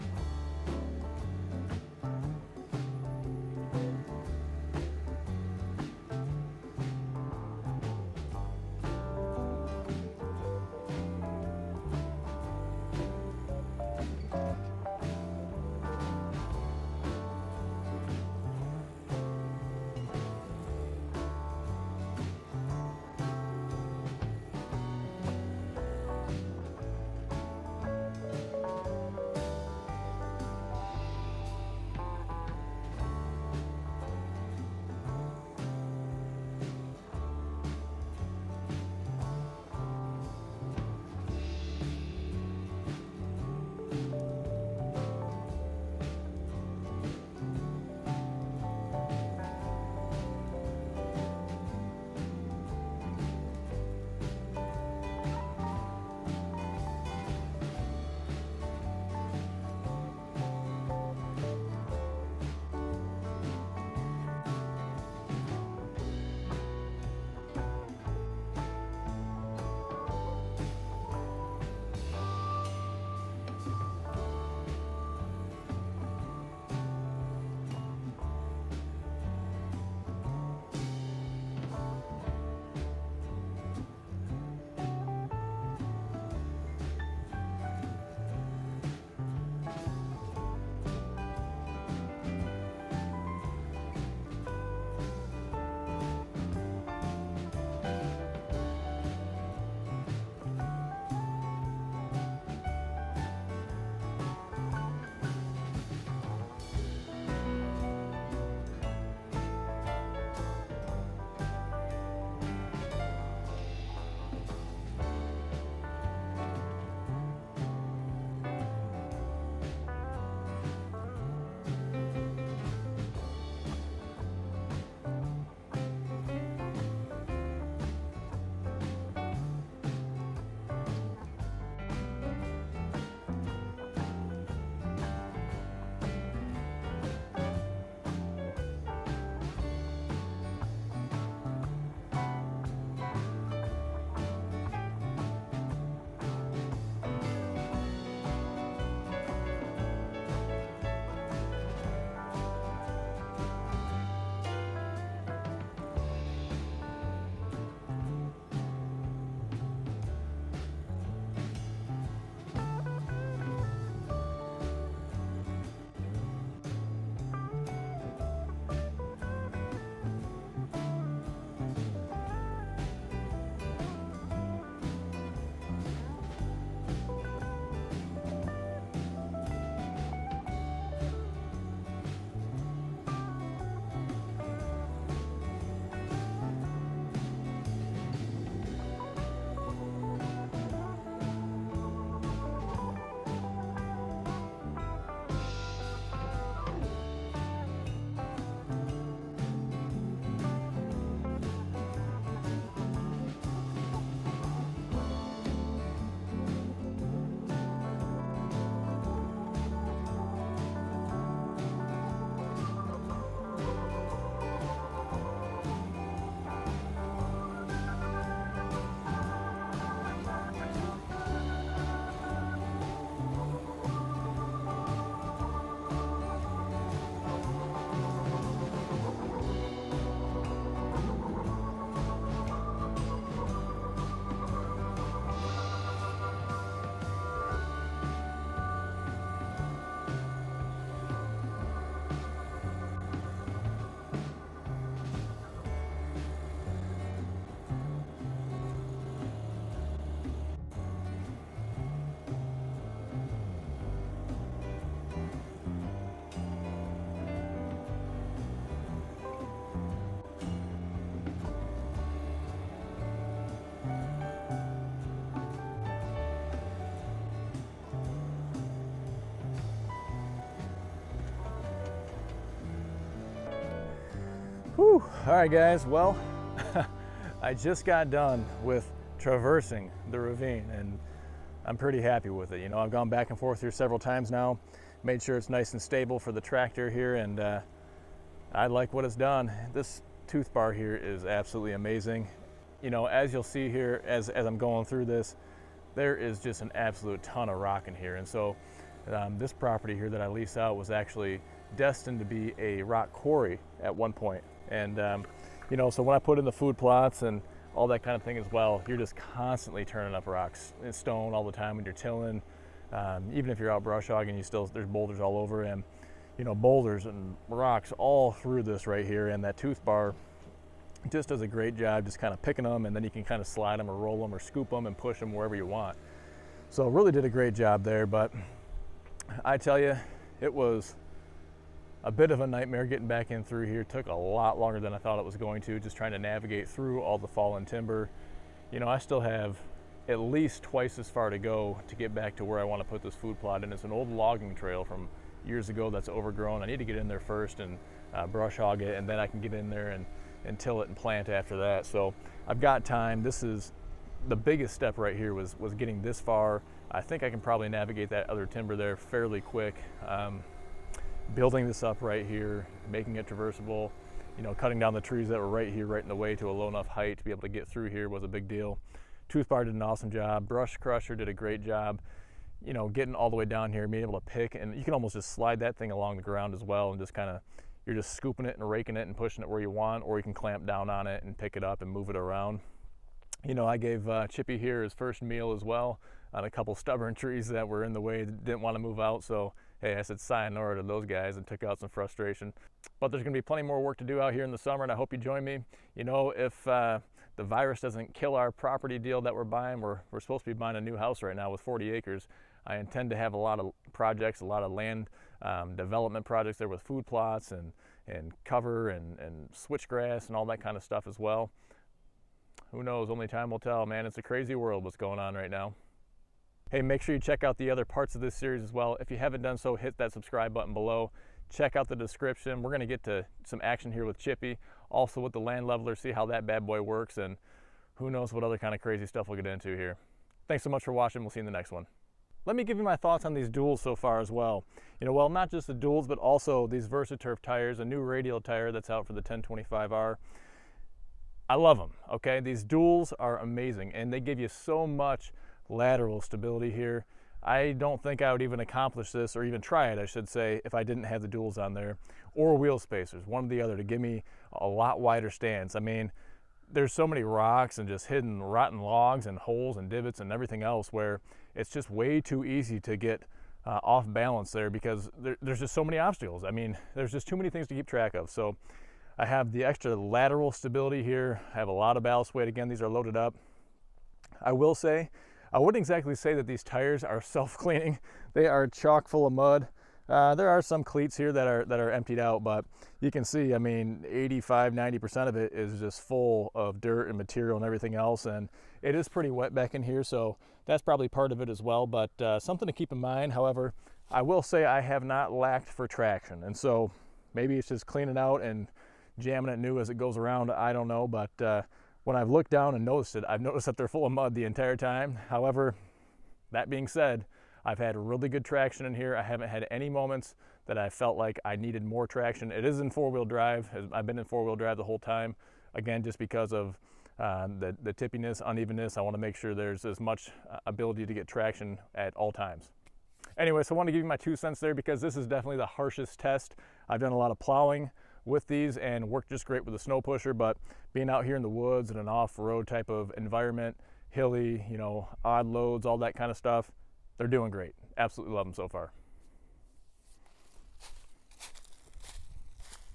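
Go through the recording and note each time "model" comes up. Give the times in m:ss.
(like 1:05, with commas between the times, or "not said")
not said.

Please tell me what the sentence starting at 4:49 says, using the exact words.
This tooth bar here is absolutely amazing.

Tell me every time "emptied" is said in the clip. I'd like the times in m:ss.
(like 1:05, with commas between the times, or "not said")
8:01.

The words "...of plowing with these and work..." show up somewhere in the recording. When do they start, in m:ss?
8:47.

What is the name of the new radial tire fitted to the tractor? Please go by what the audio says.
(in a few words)
VersaTurf.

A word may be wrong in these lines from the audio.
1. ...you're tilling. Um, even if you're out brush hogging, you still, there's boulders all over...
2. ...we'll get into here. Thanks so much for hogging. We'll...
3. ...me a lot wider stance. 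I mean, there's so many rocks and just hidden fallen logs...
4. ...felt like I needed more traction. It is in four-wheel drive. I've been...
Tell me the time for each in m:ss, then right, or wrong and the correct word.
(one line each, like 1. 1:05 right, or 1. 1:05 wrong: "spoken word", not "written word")
1. 5:11 right
2. 7:09 wrong: "watching", not "hogging"
3. 7:34 wrong: "rotten", not "fallen"
4. 8:30 right.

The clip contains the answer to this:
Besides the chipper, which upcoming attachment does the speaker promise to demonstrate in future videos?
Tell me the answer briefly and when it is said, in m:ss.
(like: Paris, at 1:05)
land leveler, at 7:05.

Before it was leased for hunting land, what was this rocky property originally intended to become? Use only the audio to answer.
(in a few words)
rock quarry.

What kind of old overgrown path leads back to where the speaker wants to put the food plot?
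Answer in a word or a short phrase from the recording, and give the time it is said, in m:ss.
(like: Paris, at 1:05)
logging trail, at 5:44.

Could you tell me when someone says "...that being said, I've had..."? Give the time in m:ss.
8:26.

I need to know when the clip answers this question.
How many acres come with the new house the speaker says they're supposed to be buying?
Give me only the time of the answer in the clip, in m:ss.
6:41.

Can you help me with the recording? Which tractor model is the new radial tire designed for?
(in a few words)
1025R.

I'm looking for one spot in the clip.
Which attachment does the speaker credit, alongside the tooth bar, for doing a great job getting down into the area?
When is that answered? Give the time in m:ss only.
6:10.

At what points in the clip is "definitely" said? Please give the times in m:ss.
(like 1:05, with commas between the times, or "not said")
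8:45.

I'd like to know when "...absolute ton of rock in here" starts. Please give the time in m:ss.
4:56.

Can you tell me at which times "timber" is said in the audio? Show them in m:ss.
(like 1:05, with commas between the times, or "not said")
5:37, 5:58.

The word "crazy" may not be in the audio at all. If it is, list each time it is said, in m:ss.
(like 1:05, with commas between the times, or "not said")
6:54, 7:08.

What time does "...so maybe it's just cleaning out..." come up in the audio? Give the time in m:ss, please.
8:16.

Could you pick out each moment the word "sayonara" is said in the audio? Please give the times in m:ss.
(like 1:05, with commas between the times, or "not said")
6:30.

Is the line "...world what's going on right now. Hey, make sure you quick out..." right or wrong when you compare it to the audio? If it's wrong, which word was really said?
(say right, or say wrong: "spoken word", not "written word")
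wrong: "check", not "quick".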